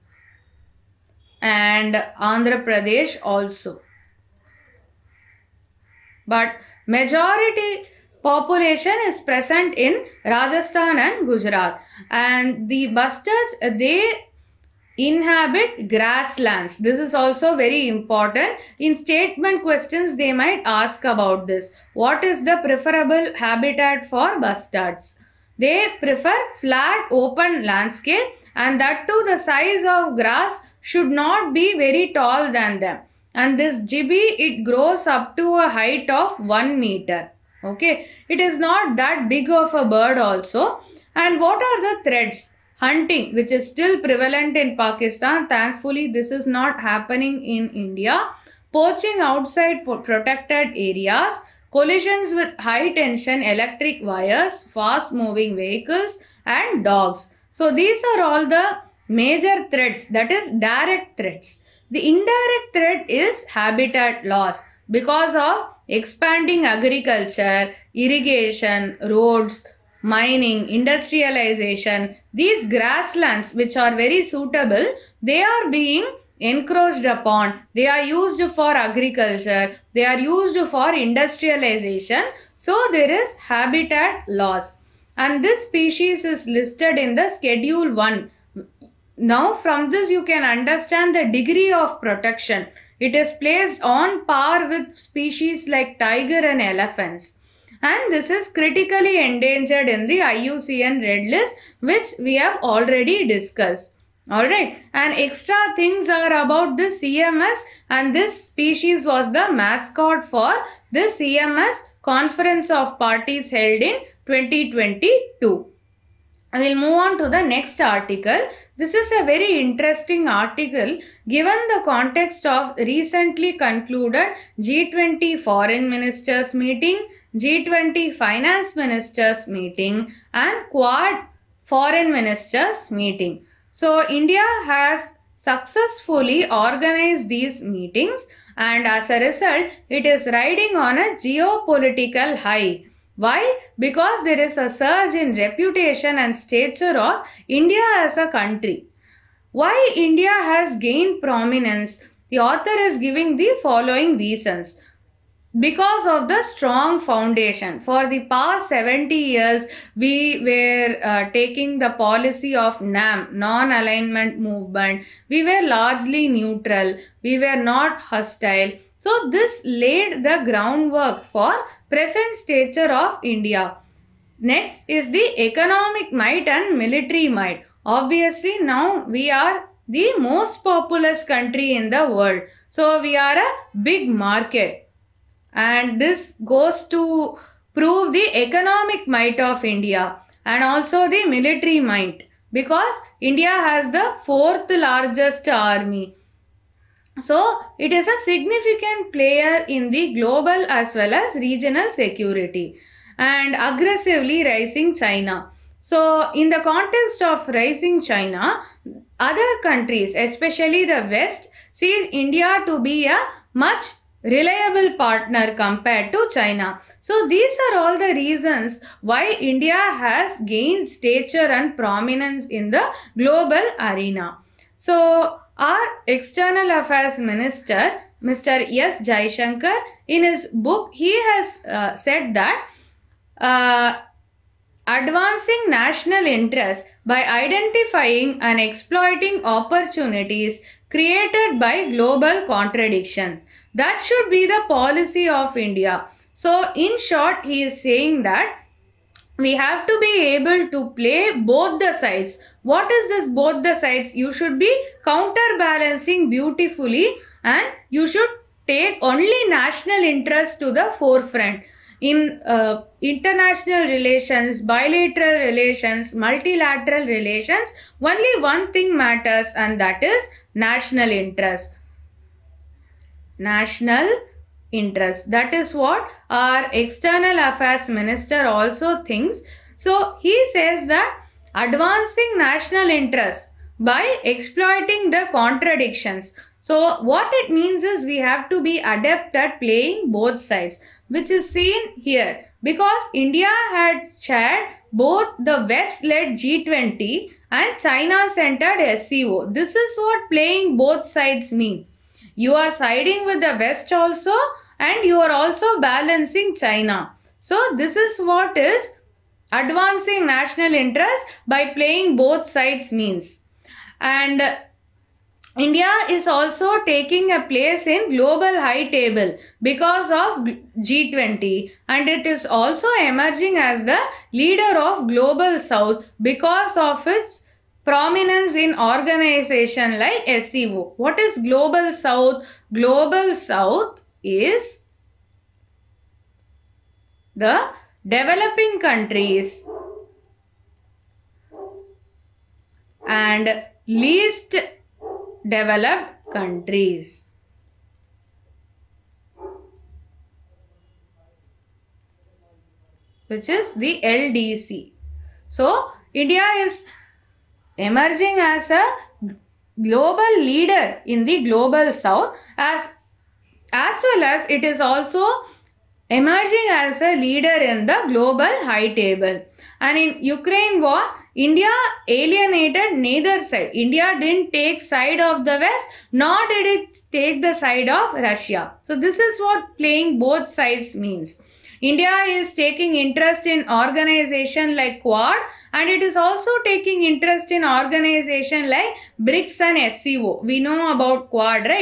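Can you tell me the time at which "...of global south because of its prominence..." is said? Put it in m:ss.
5:24.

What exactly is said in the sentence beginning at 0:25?
They prefer flat open landscape and that too the size of grass should not be very tall than them.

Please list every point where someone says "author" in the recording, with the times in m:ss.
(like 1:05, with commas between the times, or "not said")
2:32.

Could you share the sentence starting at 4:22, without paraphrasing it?
In uh, international relations, bilateral relations, multilateral relations, only one thing matters and that is national interest.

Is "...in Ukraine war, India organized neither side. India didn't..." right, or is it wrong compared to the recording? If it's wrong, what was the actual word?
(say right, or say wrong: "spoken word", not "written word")
wrong: "alienated", not "organized".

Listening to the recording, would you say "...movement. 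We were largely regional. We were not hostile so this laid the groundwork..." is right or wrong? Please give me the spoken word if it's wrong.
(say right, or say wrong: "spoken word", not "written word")
wrong: "neutral", not "regional".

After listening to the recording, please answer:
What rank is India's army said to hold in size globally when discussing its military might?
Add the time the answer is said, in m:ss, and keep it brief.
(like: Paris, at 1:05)
Fourth largest, at 3:14.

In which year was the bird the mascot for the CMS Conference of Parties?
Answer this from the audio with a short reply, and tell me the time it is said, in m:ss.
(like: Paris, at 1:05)
2022, at 1:54.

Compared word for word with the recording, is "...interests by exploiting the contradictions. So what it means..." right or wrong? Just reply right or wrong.
right.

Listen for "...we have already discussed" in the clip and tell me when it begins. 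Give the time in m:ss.
1:42.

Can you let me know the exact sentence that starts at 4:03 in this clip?
That should be the policy of India.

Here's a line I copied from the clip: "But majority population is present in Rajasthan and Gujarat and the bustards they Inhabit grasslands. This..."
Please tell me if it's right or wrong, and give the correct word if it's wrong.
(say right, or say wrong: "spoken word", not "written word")
right.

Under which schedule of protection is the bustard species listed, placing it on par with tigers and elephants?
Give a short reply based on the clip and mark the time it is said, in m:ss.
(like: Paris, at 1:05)
Schedule 1, at 1:27.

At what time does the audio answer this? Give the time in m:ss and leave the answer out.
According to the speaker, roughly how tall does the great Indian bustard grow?
0:36.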